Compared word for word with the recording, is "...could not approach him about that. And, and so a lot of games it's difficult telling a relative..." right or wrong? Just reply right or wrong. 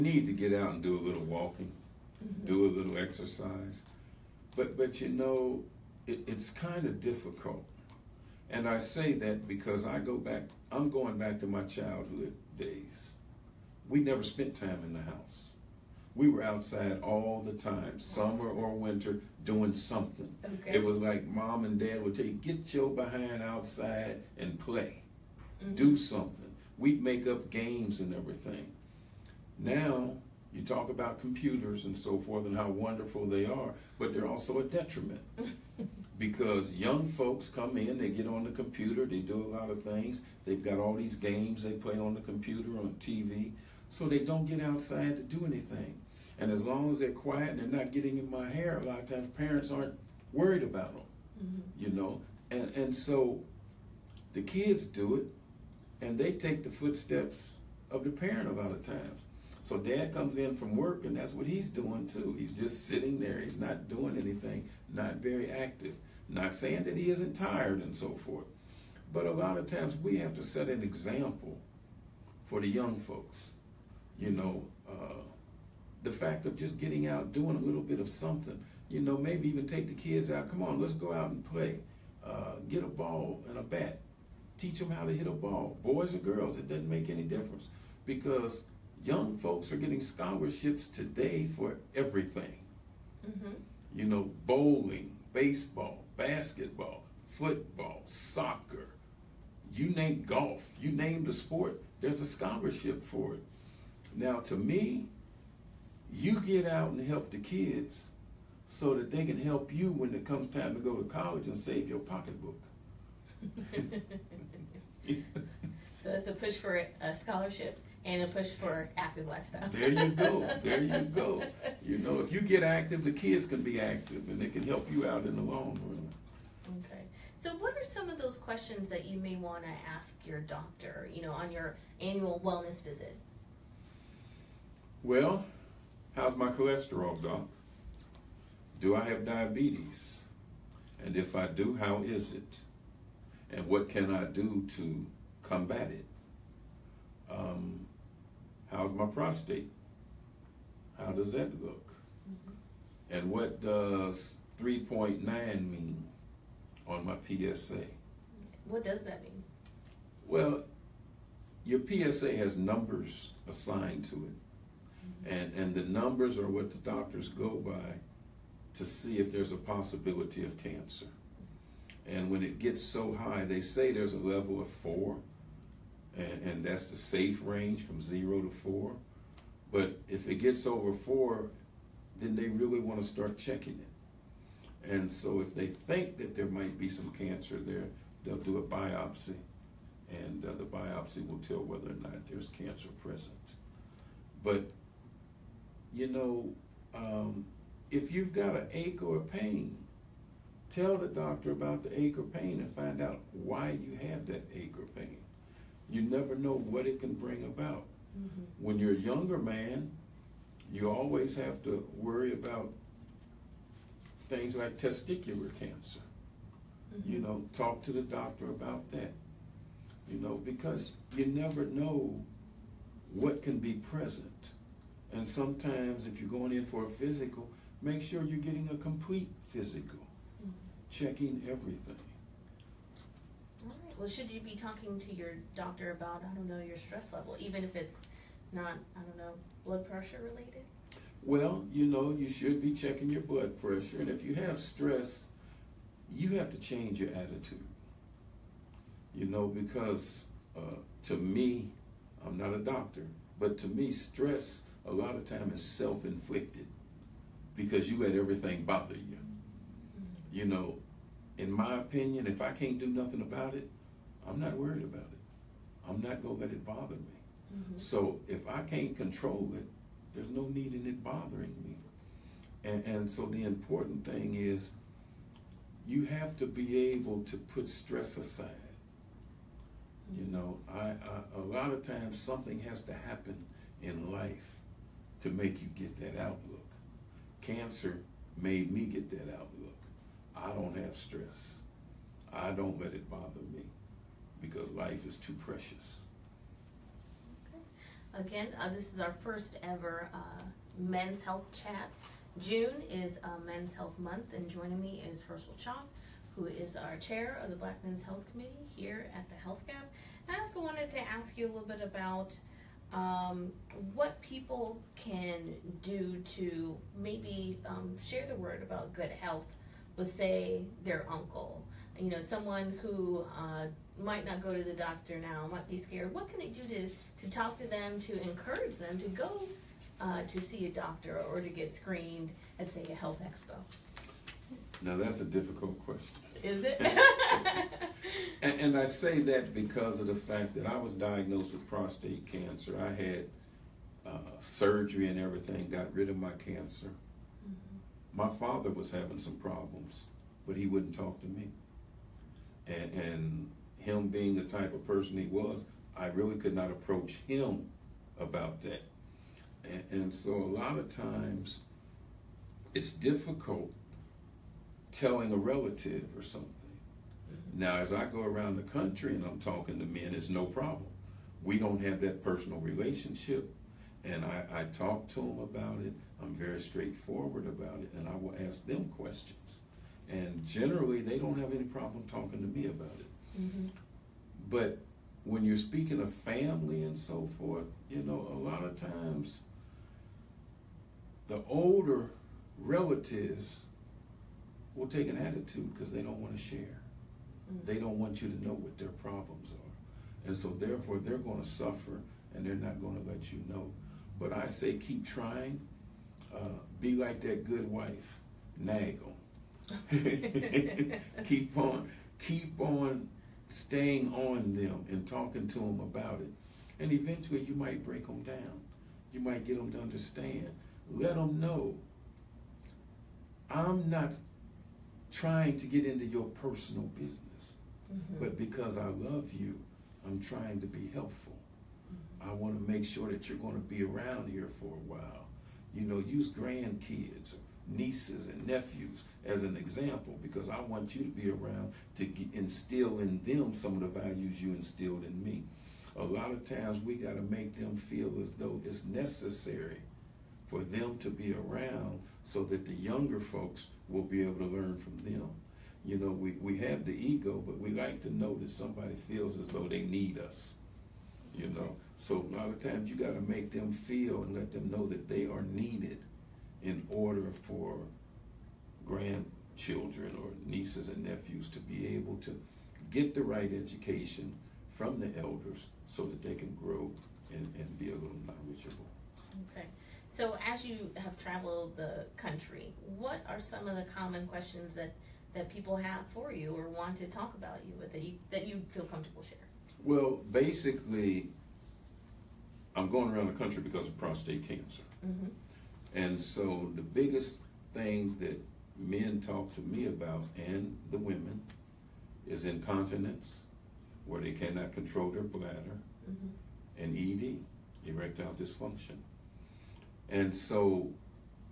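wrong.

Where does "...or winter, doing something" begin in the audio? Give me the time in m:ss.
0:18.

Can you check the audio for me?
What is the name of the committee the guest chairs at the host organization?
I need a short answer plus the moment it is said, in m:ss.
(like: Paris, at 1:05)
Black Men's Health Committee, at 5:07.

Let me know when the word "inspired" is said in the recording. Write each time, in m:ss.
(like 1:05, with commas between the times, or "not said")
not said.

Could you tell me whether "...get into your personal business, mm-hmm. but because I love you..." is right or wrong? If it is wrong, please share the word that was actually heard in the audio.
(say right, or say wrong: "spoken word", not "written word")
right.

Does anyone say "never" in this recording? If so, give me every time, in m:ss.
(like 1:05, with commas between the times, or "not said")
0:13, 3:26, 3:41.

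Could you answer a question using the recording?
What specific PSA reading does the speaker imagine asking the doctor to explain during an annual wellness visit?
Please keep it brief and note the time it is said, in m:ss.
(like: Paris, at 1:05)
3.9, at 2:34.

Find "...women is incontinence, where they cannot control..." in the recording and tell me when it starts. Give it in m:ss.
8:20.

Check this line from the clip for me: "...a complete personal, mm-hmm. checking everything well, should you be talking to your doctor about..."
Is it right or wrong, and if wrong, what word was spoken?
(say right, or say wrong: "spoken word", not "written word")
wrong: "physical", not "personal".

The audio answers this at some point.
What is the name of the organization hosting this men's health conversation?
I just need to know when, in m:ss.
5:09.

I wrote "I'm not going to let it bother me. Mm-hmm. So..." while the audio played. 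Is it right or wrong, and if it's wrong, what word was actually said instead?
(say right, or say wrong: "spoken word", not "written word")
right.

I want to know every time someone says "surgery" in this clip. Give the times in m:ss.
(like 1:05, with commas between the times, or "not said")
5:44.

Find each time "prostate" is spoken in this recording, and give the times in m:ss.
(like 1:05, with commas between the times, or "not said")
2:29, 5:41, 8:13.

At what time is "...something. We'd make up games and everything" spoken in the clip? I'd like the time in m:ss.
0:25.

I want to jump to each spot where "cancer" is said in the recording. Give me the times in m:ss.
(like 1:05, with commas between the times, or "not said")
2:50, 3:07, 3:12, 3:35, 4:47, 5:42, 5:46, 8:14.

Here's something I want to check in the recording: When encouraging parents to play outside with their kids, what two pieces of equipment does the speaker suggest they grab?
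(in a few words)
a ball and a bat.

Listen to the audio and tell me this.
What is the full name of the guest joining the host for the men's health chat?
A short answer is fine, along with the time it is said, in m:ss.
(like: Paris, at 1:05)
Herschel Chalk, at 5:05.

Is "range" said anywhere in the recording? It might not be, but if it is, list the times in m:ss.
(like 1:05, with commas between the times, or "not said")
2:57.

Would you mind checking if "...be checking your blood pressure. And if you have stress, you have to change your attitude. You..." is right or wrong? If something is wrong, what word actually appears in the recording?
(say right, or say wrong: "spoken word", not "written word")
right.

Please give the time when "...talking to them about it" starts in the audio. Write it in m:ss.
6:55.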